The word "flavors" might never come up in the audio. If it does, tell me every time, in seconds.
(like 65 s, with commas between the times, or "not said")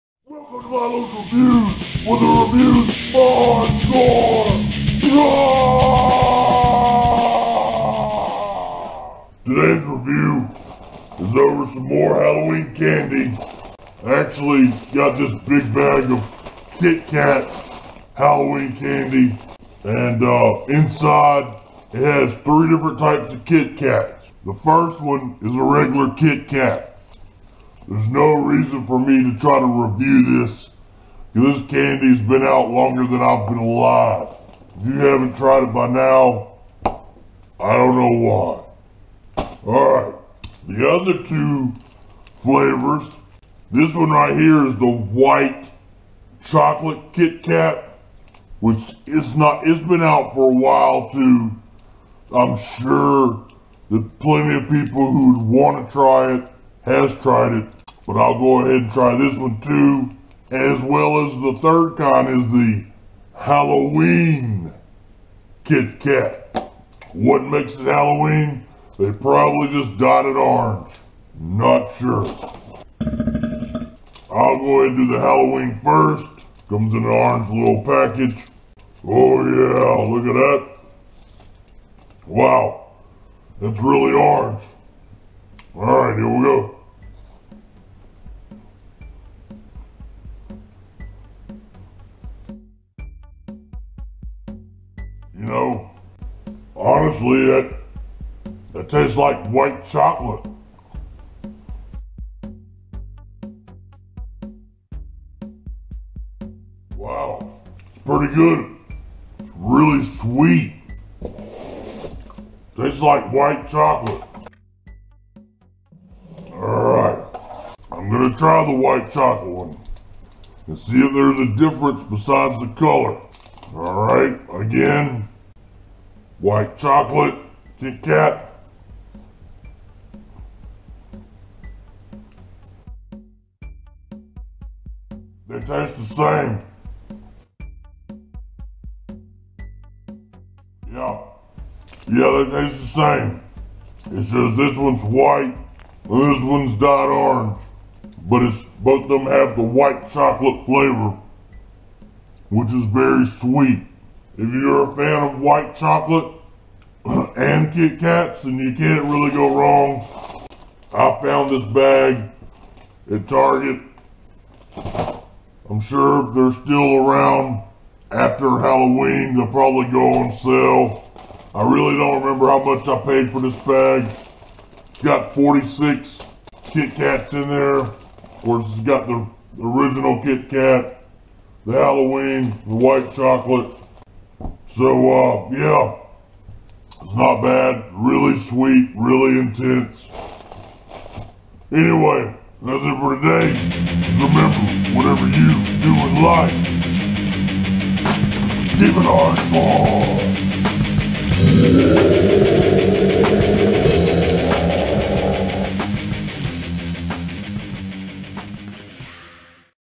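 42 s, 150 s.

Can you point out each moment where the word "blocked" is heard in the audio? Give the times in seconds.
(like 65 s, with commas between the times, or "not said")
not said.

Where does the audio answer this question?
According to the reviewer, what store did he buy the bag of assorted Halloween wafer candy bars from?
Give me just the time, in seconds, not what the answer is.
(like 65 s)
163 s.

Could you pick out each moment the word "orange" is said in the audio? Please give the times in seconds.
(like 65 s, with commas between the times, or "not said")
70 s, 77 s, 84 s, 147 s.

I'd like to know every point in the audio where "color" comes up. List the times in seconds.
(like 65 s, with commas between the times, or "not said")
122 s.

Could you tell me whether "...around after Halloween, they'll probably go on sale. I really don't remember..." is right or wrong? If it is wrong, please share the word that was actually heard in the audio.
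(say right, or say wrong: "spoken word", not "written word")
right.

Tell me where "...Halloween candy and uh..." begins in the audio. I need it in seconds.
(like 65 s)
18 s.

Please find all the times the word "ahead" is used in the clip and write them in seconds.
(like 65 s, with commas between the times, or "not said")
58 s, 74 s.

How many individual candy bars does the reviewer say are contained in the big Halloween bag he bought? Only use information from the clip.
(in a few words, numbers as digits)
46.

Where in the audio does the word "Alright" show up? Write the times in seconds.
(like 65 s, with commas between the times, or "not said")
39 s, 116 s, 123 s.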